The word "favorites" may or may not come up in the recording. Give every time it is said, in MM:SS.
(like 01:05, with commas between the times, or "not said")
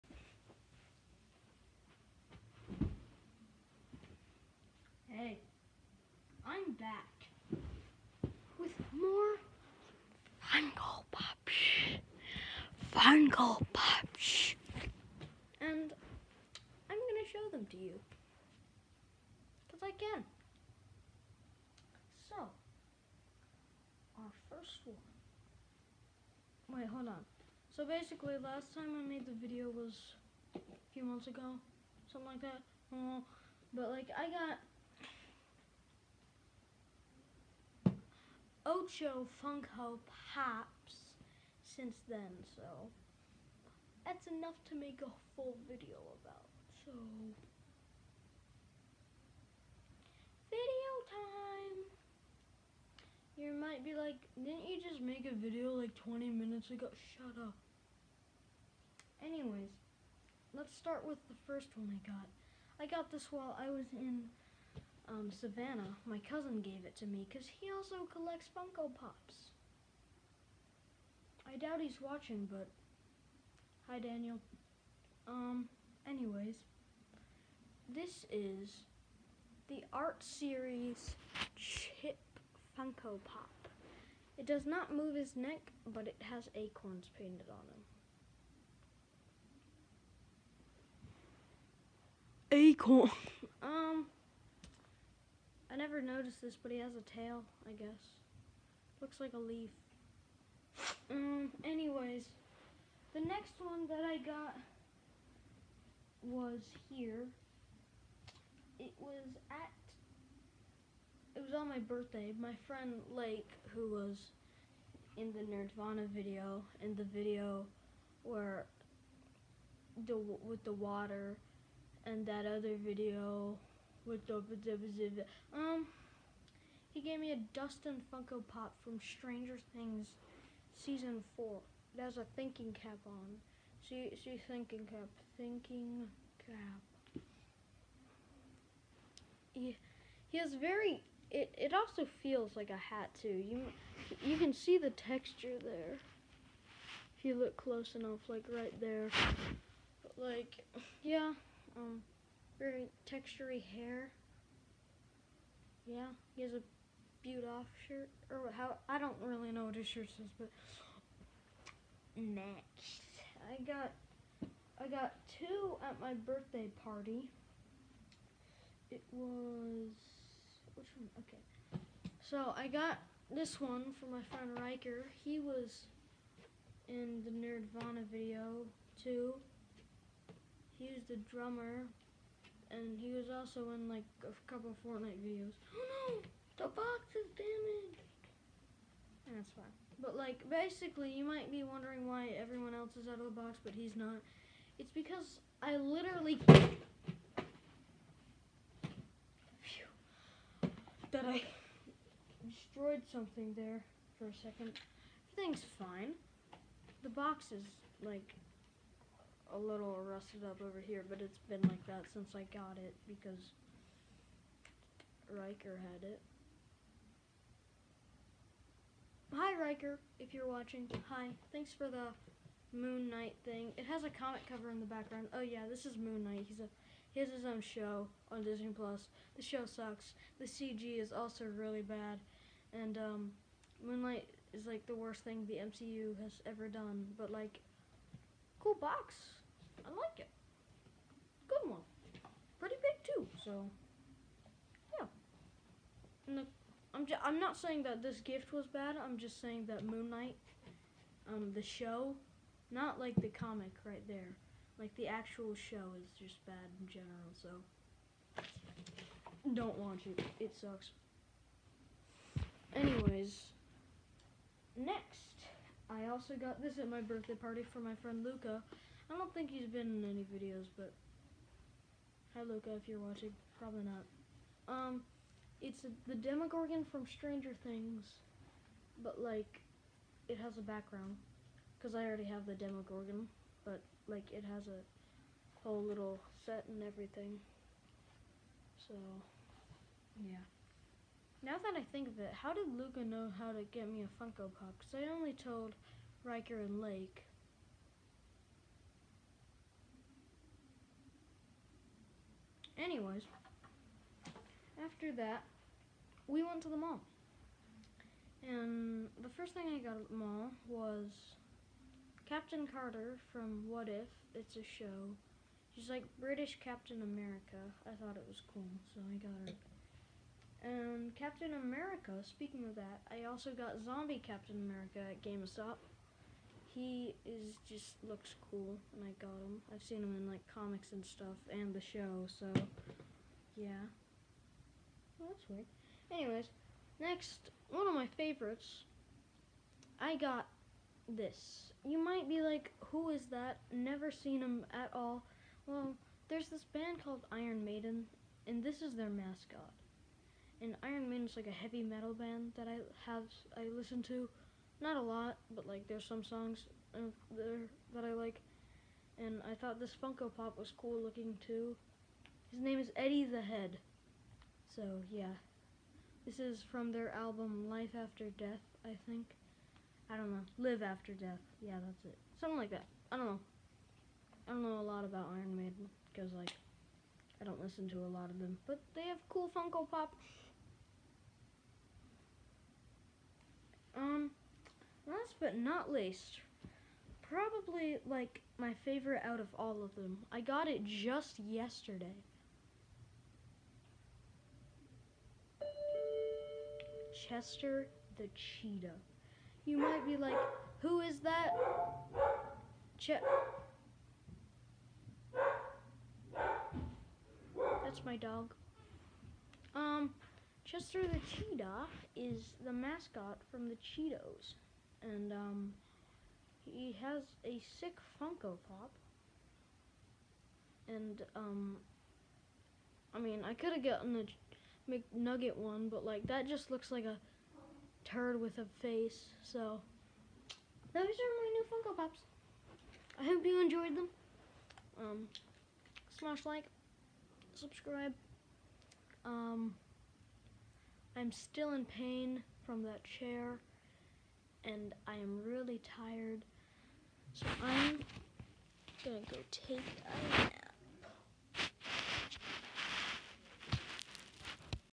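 05:38, 06:28.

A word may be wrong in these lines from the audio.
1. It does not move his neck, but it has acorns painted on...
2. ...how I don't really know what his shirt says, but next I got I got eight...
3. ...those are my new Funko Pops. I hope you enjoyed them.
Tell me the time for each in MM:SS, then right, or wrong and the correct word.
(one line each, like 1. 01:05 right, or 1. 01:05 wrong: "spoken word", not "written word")
1. 01:24 right
2. 02:38 wrong: "two", not "eight"
3. 07:10 right.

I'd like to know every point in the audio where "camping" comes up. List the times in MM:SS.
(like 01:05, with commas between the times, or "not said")
not said.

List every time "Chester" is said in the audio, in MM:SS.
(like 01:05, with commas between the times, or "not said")
06:37, 06:50.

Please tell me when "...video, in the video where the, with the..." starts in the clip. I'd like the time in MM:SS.
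01:56.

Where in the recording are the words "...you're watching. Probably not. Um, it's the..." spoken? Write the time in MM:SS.
04:32.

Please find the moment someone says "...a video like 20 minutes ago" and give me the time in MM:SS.
00:55.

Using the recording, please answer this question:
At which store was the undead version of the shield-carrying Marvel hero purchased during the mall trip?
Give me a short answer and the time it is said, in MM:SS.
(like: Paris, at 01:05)
GameStop, at 05:25.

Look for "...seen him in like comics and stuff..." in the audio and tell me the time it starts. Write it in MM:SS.
05:29.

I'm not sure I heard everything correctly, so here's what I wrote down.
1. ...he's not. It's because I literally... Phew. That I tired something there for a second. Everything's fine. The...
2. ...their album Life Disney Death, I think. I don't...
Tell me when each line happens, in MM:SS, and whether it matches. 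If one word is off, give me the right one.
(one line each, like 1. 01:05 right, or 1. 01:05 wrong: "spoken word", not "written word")
1. 03:13 wrong: "destroyed", not "tired"
2. 06:06 wrong: "After", not "Disney".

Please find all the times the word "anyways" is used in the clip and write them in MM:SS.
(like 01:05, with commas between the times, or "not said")
00:59, 01:16, 01:41, 04:22, 05:02, 05:36.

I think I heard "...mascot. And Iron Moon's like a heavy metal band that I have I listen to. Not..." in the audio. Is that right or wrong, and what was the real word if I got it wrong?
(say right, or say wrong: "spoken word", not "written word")
wrong: "Maiden", not "Moon".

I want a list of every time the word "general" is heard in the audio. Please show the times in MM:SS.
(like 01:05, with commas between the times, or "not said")
04:16.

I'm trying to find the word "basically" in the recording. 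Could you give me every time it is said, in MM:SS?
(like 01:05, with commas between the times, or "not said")
00:27, 03:10.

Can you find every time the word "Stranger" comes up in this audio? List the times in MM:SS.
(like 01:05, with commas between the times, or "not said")
02:08, 04:37.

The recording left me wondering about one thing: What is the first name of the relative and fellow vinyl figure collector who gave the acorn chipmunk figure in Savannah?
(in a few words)
Daniel.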